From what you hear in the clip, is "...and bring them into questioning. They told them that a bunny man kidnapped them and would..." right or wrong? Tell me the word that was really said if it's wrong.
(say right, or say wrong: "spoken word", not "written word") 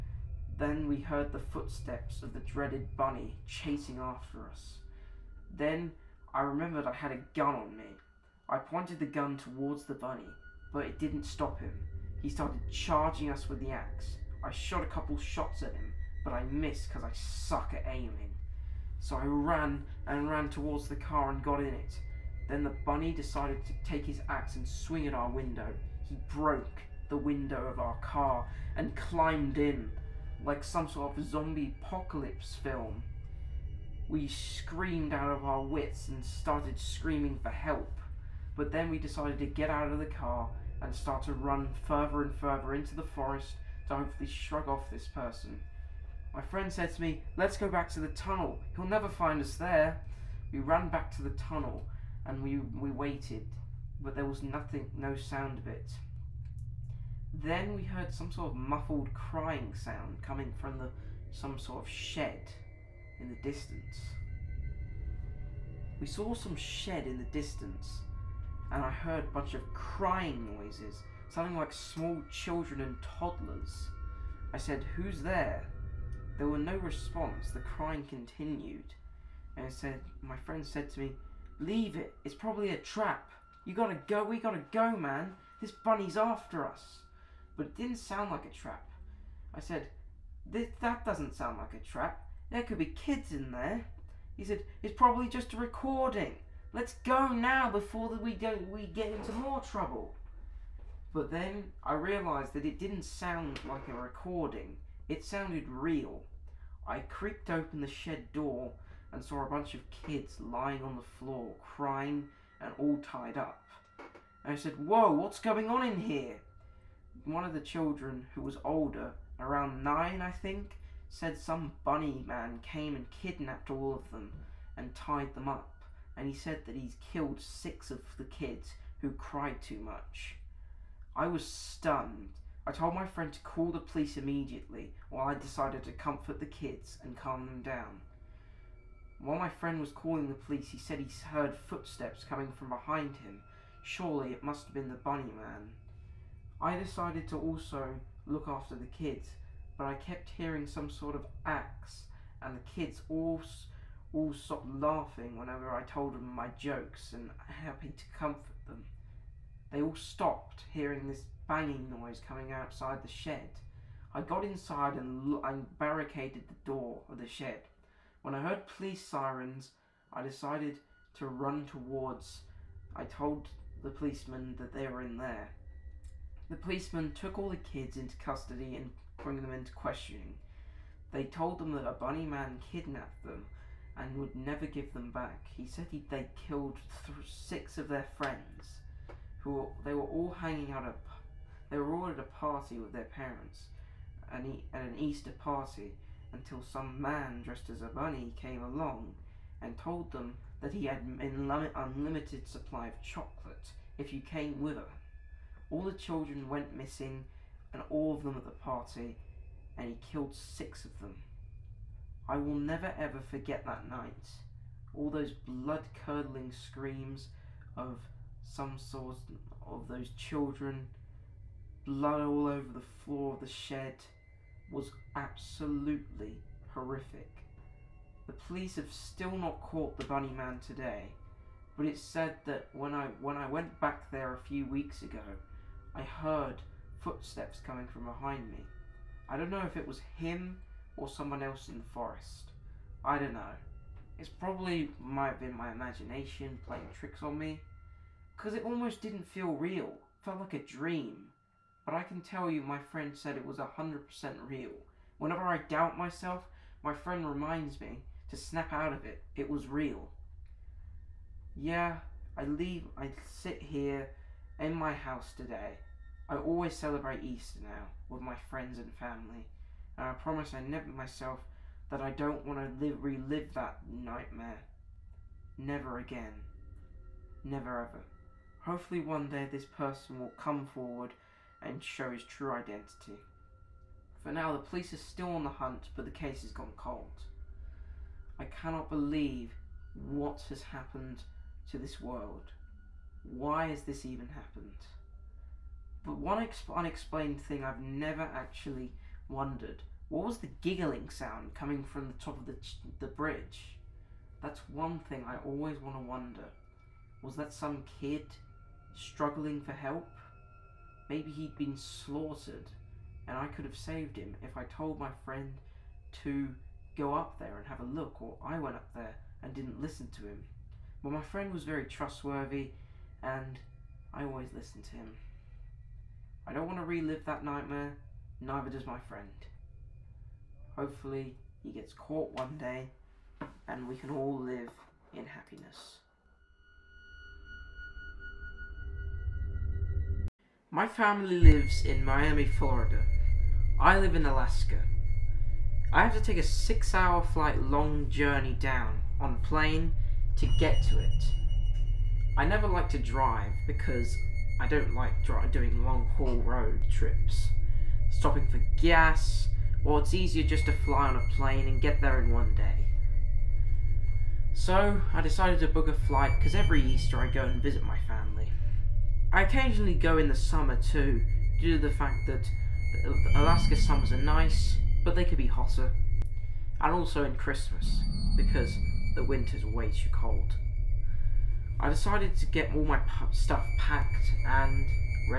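right.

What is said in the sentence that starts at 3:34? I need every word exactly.
All those blood curdling screams of some sort of those children, blood all over the floor of the shed, was absolutely horrific.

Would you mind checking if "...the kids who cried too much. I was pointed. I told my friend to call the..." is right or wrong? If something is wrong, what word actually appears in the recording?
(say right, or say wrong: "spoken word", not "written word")
wrong: "stunned", not "pointed".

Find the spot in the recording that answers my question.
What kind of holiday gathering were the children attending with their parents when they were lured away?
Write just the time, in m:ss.
3:14.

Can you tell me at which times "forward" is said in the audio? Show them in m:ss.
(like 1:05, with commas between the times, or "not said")
4:40.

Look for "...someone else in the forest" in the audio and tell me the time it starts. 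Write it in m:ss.
4:01.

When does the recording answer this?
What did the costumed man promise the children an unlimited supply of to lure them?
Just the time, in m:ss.
3:23.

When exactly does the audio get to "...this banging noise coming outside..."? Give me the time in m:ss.
2:41.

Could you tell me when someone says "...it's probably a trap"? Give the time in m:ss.
1:22.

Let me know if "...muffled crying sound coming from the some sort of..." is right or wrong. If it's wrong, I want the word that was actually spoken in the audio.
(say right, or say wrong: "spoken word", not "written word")
right.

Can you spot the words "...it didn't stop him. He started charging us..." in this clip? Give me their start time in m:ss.
0:10.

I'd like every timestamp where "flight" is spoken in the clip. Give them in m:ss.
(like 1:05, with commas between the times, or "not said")
5:47, 6:05.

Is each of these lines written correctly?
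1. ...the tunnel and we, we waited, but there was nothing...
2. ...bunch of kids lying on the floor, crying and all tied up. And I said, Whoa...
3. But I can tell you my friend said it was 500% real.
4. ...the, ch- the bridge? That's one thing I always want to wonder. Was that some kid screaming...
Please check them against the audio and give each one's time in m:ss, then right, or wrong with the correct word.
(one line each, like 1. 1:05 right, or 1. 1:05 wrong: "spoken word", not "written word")
1. 0:51 right
2. 1:49 right
3. 4:11 wrong: "100", not "500"
4. 5:02 wrong: "struggling", not "screaming".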